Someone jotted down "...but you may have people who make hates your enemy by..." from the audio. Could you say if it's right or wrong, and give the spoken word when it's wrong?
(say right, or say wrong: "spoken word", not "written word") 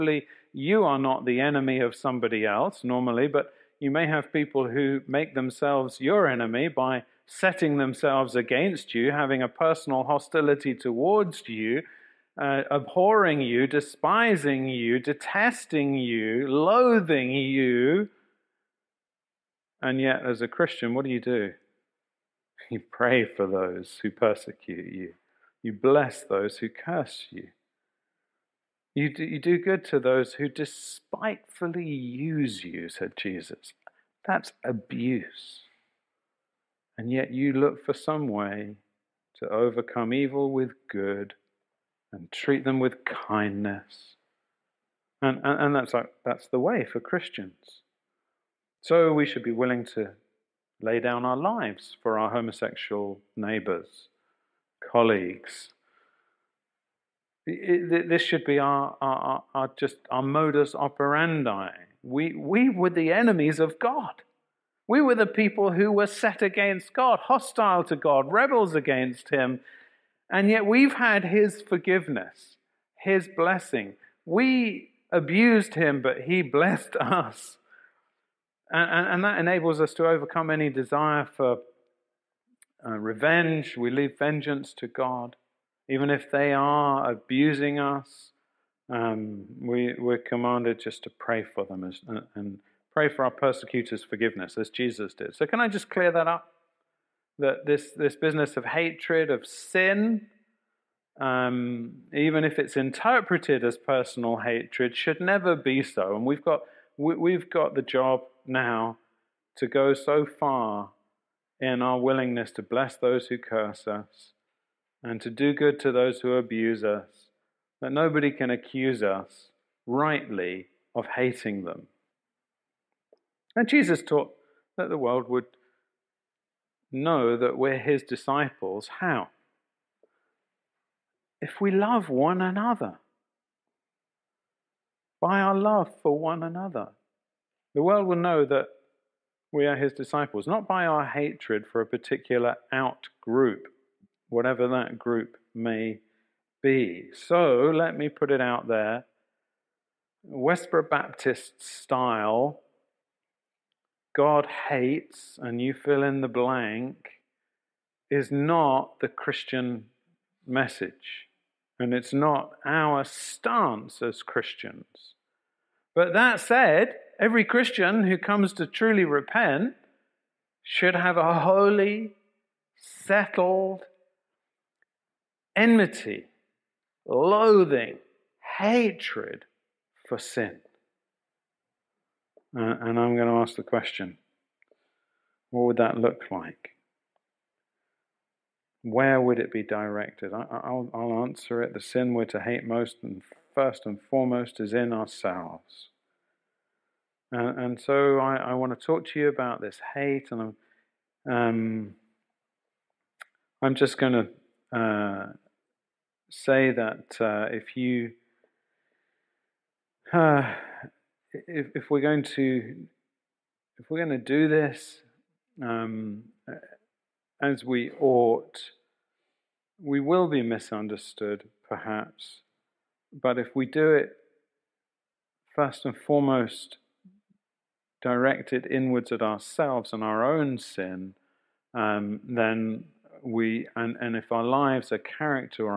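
wrong: "themselves", not "hates".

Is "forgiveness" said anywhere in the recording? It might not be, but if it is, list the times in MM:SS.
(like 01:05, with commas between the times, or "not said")
01:11, 01:34.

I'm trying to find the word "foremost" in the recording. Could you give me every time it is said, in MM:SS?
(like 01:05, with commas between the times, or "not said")
03:14, 03:45.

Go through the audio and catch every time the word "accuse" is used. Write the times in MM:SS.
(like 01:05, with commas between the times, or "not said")
01:58.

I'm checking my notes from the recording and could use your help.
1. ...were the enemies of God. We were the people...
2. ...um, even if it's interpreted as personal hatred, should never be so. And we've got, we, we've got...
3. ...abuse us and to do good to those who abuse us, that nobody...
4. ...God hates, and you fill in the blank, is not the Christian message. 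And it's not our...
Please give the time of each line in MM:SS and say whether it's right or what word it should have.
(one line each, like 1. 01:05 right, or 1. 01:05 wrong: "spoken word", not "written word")
1. 01:02 right
2. 01:41 right
3. 01:53 wrong: "curse", not "abuse"
4. 02:34 right.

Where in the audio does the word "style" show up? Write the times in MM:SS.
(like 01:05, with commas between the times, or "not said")
02:31.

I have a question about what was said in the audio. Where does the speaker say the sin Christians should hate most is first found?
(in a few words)
In ourselves.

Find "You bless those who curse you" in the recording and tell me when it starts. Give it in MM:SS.
00:25.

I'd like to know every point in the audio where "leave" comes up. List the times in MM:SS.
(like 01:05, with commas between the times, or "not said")
01:23.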